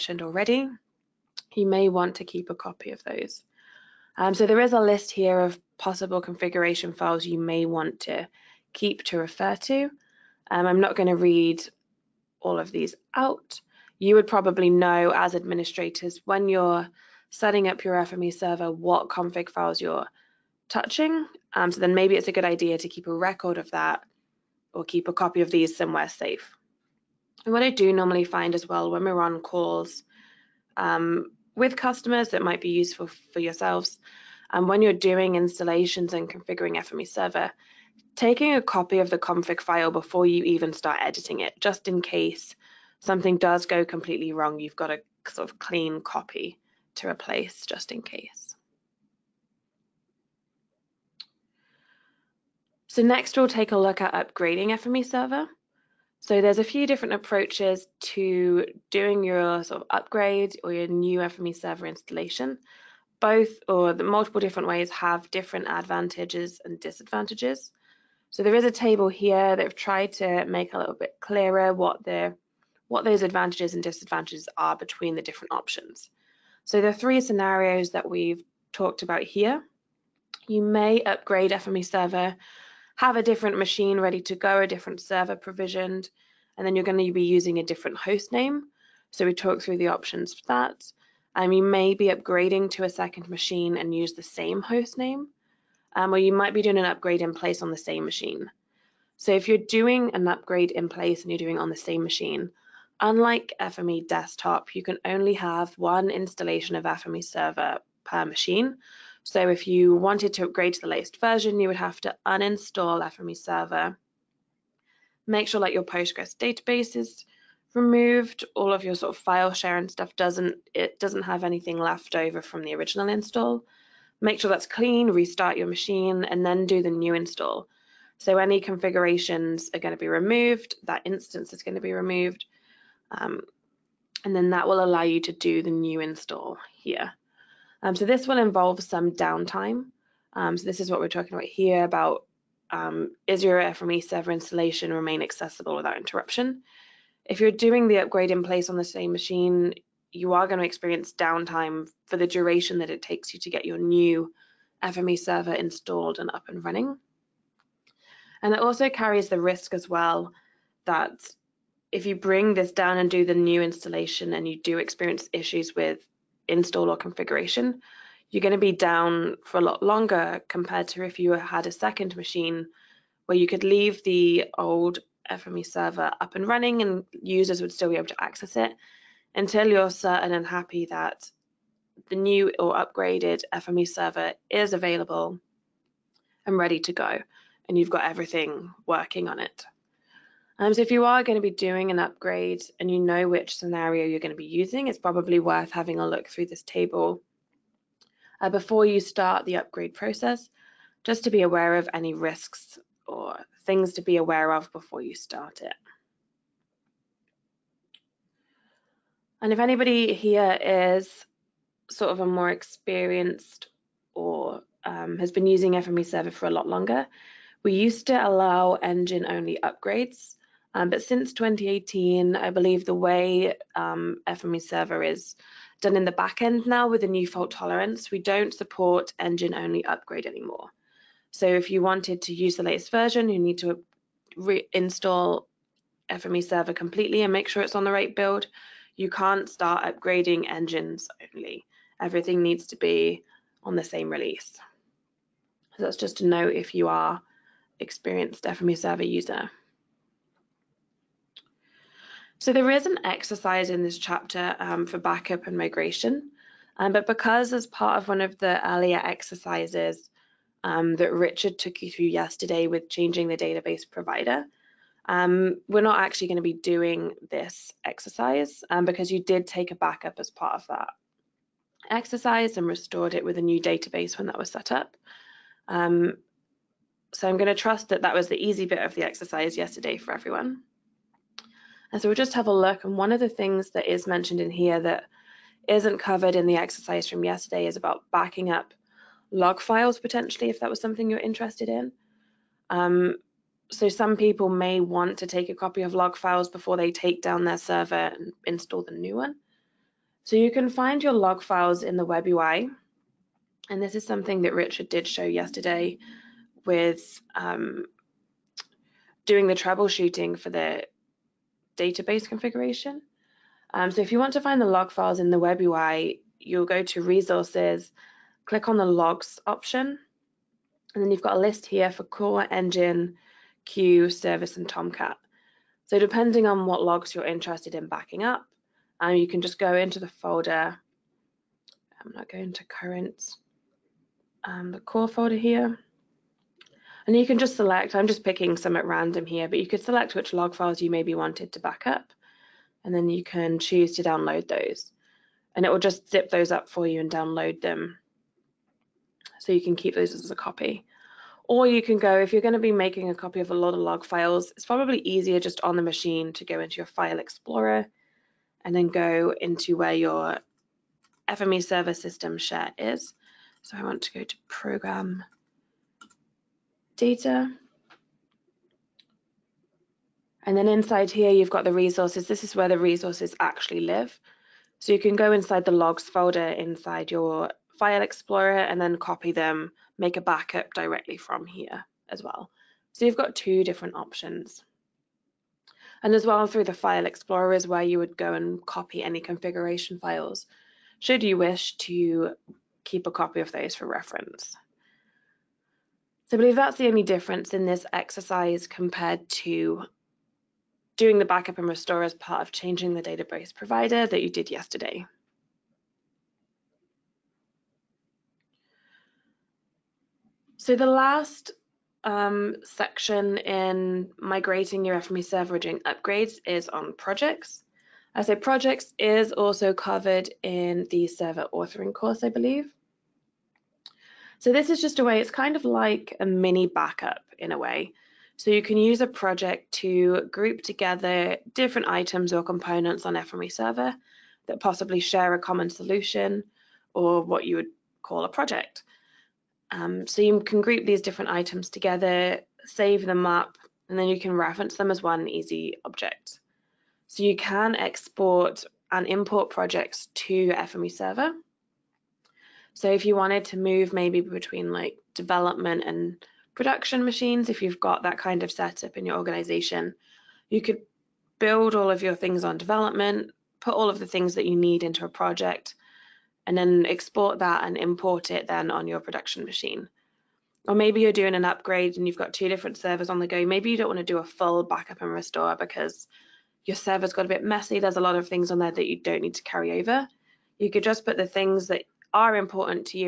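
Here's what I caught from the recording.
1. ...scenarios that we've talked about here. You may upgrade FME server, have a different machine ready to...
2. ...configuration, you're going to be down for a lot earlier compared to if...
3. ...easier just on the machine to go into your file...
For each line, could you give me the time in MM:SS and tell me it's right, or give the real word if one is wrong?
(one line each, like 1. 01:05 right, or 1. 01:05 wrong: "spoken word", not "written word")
1. 01:17 right
2. 02:46 wrong: "longer", not "earlier"
3. 05:54 right.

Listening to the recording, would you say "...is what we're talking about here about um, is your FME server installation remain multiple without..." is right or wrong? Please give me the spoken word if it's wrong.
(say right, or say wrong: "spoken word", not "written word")
wrong: "accessible", not "multiple".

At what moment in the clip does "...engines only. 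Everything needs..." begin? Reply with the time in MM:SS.
04:00.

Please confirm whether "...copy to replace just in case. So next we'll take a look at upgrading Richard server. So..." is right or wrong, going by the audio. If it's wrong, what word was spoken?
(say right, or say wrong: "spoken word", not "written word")
wrong: "FME", not "Richard".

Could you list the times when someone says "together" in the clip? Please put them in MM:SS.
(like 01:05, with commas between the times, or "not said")
07:10, 07:21.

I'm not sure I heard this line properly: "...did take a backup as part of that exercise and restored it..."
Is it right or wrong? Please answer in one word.
right.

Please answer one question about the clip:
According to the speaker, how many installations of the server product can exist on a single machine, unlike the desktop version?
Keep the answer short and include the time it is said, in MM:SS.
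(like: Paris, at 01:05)
1, at 01:45.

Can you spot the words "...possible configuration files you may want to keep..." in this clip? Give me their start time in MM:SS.
00:05.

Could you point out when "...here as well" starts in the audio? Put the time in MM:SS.
06:21.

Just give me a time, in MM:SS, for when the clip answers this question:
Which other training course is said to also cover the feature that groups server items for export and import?
07:01.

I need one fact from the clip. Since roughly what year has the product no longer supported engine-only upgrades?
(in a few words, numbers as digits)
2018.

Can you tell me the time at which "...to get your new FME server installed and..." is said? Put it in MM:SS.
02:33.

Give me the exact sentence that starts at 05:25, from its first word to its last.
So depending on what logs you're interested in backing up, um, you can just go into the folder.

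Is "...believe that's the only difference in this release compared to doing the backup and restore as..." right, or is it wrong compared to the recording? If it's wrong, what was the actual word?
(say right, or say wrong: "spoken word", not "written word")
wrong: "exercise", not "release".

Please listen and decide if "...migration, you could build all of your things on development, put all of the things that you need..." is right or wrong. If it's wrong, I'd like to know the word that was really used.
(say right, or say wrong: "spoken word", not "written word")
wrong: "organization", not "migration".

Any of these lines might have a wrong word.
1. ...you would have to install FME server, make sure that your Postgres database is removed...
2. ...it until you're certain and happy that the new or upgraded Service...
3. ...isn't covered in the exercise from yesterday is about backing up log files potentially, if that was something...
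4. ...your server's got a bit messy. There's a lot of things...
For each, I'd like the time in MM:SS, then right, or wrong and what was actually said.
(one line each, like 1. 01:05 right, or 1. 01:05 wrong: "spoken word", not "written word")
1. 01:51 wrong: "uninstall", not "install"
2. 02:58 wrong: "FME", not "Service"
3. 04:45 right
4. 07:56 right.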